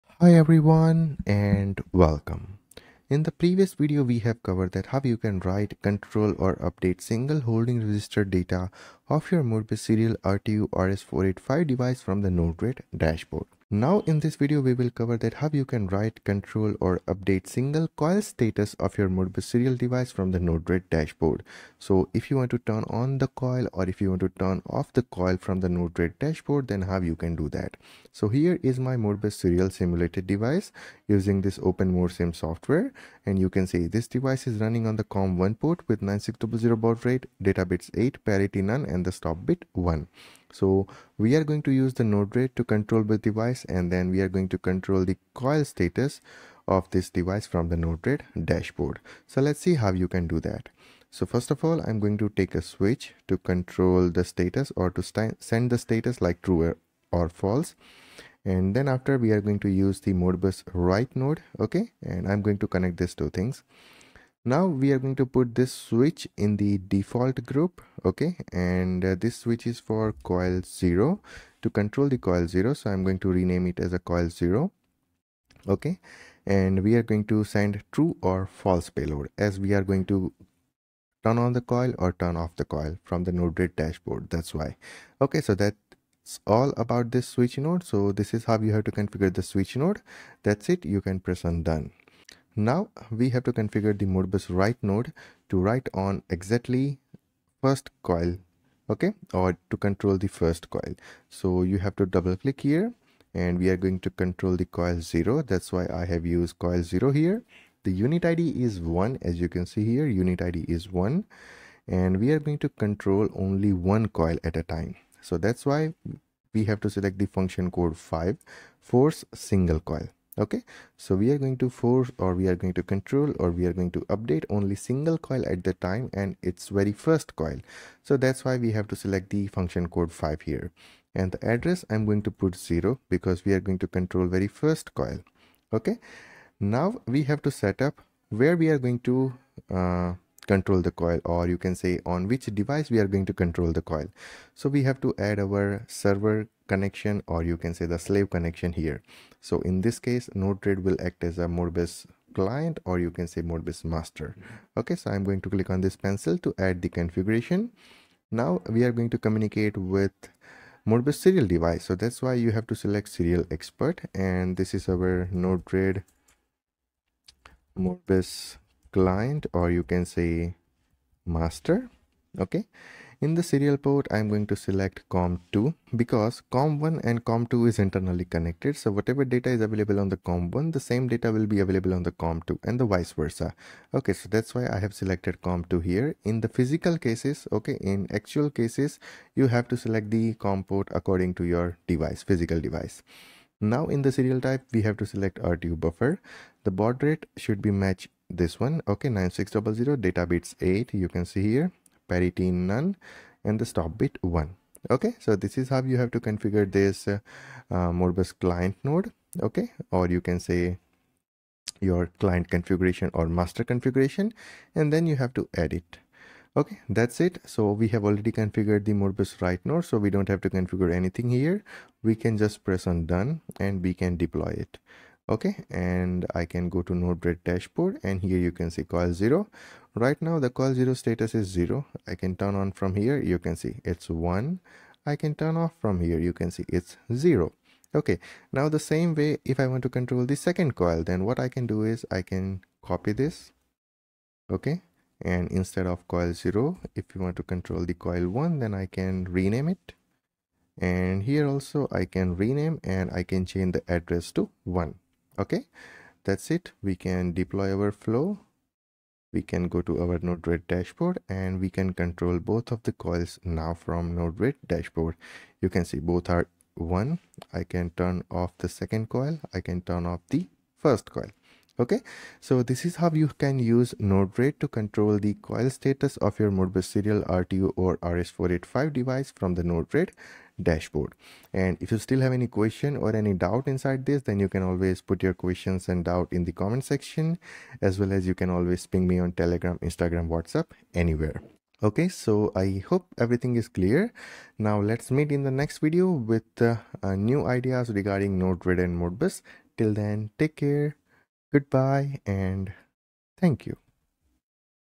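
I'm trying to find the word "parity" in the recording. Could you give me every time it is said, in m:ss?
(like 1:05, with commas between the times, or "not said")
0:38, 3:22.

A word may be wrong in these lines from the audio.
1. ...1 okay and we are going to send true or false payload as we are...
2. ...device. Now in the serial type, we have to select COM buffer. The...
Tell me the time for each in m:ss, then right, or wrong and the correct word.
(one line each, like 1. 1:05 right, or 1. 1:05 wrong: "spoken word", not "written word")
1. 1:14 wrong: "0", not "1"
2. 3:12 wrong: "RTU", not "COM".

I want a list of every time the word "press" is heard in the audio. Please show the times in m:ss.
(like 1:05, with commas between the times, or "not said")
1:31, 3:42.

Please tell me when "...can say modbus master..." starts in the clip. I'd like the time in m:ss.
2:33.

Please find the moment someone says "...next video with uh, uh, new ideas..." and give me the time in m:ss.
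4:55.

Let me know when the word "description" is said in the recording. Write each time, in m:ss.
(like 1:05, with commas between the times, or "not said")
not said.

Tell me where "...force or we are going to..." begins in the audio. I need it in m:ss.
2:01.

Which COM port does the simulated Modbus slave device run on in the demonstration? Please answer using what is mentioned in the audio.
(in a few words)
COM1.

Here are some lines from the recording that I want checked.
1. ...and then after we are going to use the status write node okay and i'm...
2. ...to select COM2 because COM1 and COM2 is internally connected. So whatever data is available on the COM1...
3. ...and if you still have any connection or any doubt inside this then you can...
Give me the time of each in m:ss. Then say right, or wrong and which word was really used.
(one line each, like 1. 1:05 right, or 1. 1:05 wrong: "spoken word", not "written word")
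1. 0:58 wrong: "modbus", not "status"
2. 2:54 right
3. 4:41 wrong: "question", not "connection".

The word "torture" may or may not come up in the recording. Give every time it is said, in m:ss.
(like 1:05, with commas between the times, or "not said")
not said.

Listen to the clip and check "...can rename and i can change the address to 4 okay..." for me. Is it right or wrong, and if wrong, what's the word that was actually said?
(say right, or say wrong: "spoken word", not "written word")
wrong: "1", not "4".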